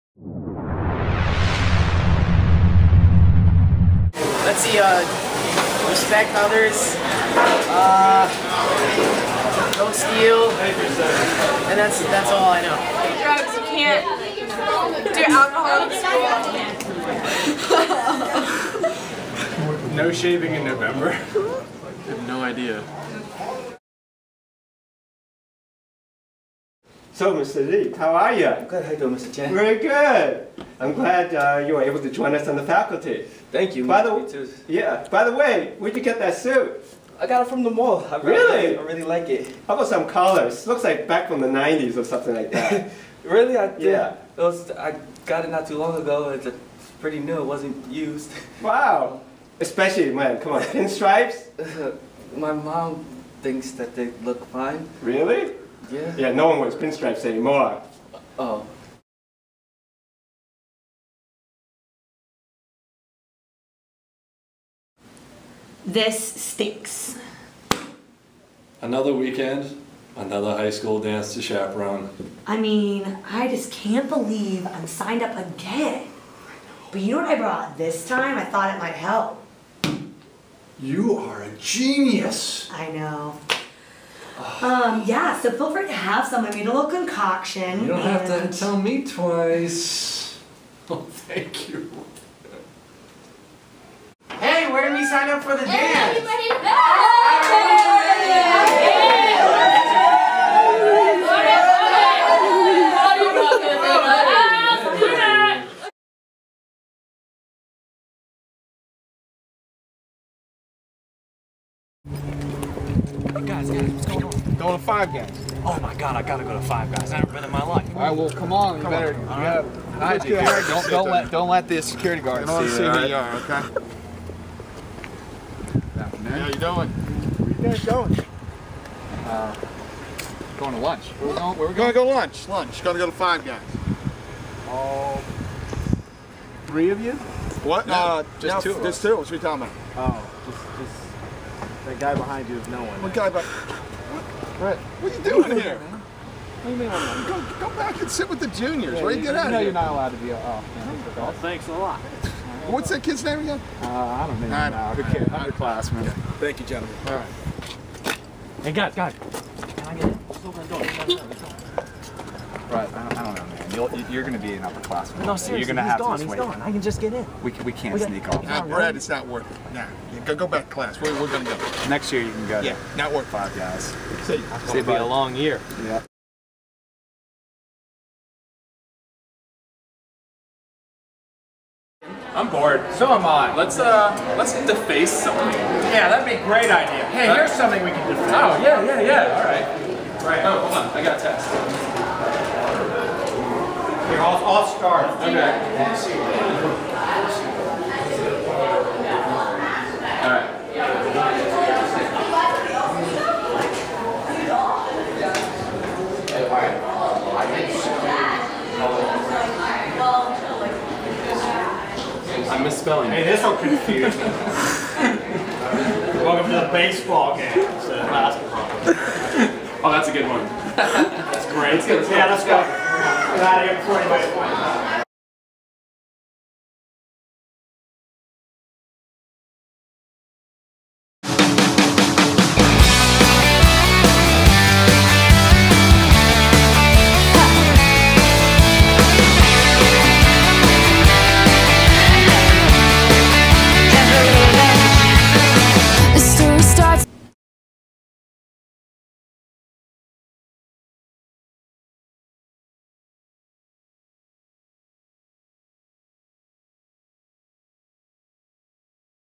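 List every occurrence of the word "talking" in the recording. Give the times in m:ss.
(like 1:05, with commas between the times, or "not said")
2:19.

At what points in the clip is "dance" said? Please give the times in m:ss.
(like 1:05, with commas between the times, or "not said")
1:10, 1:35.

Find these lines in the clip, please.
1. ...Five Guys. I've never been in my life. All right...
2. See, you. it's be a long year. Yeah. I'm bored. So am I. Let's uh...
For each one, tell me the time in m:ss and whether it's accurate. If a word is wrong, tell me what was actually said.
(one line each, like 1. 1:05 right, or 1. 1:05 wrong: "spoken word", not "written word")
1. 1:56 right
2. 2:54 right.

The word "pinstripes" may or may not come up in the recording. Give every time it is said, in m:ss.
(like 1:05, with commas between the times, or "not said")
0:50, 0:56.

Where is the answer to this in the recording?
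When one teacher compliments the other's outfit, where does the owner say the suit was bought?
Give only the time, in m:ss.
0:37.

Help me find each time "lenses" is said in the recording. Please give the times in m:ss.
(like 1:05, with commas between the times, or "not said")
not said.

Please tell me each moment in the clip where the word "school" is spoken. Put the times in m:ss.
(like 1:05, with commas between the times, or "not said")
0:19, 1:10.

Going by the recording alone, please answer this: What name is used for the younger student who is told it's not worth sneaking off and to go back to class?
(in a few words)
Brad.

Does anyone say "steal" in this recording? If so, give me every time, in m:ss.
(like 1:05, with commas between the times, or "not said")
0:09.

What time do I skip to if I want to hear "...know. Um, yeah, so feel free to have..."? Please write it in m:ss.
1:22.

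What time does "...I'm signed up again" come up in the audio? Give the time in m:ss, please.
1:14.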